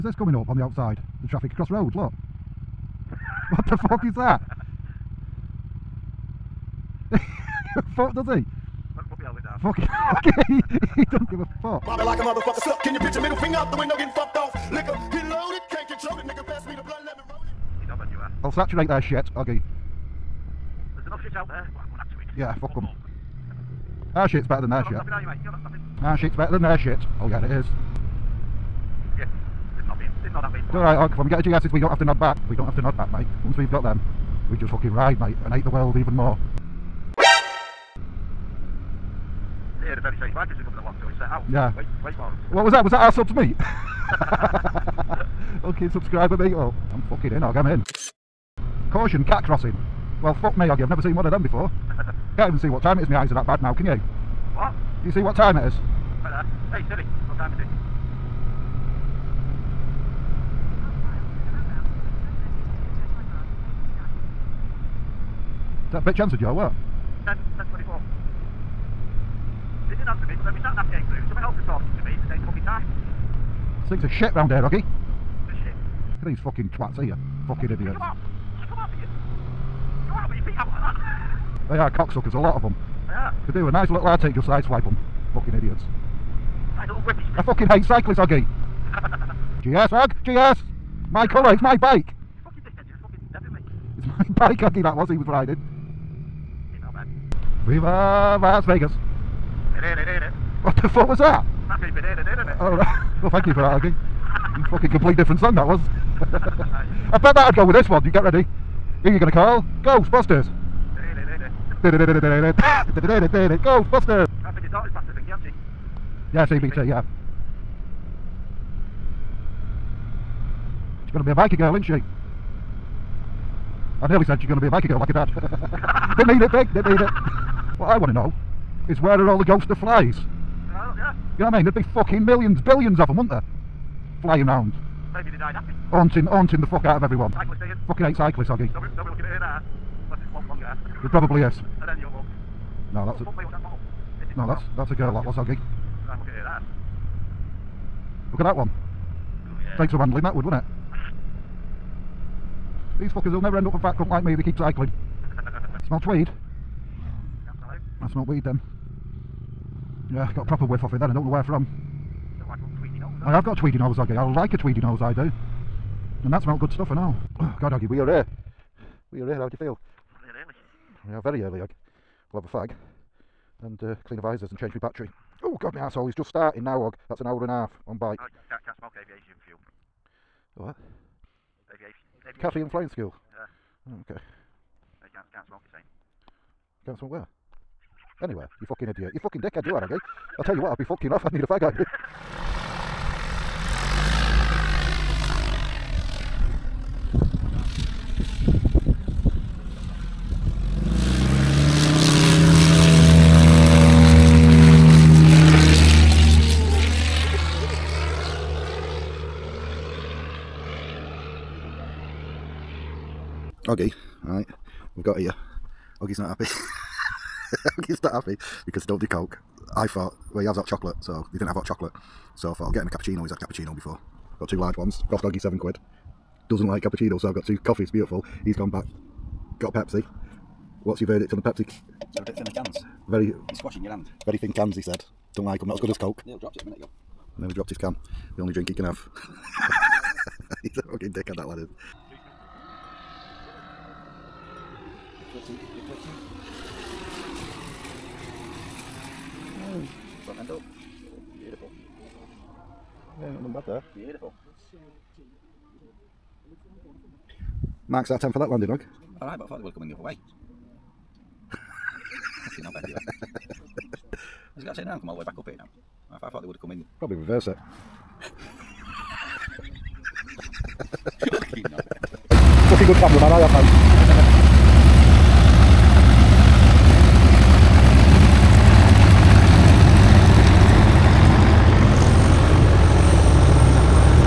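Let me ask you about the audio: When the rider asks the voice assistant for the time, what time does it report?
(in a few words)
10:24.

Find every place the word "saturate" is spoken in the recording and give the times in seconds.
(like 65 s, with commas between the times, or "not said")
18 s.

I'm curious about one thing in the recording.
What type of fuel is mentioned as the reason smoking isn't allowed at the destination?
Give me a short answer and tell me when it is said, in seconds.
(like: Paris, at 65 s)
Aviation fuel, at 178 s.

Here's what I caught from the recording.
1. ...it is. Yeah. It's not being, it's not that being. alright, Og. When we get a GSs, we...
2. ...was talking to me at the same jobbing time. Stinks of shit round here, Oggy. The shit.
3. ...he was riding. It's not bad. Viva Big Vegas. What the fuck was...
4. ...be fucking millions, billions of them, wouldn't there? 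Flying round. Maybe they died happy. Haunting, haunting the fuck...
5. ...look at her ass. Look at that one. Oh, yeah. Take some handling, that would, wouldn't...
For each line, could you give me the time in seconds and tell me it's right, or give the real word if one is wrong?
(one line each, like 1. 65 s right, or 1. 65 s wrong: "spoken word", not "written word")
1. 27 s right
2. 71 s wrong: "fucking", not "jobbing"
3. 95 s wrong: "Las", not "Big"
4. 131 s right
5. 146 s right.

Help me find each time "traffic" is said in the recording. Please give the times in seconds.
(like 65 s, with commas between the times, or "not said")
1 s.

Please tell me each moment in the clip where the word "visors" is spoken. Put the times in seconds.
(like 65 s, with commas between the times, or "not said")
174 s.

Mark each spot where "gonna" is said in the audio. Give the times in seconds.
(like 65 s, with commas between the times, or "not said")
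109 s, 121 s.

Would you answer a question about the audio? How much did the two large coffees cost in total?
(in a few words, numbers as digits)
7 pounds.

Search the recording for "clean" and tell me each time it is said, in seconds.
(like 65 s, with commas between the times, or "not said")
174 s.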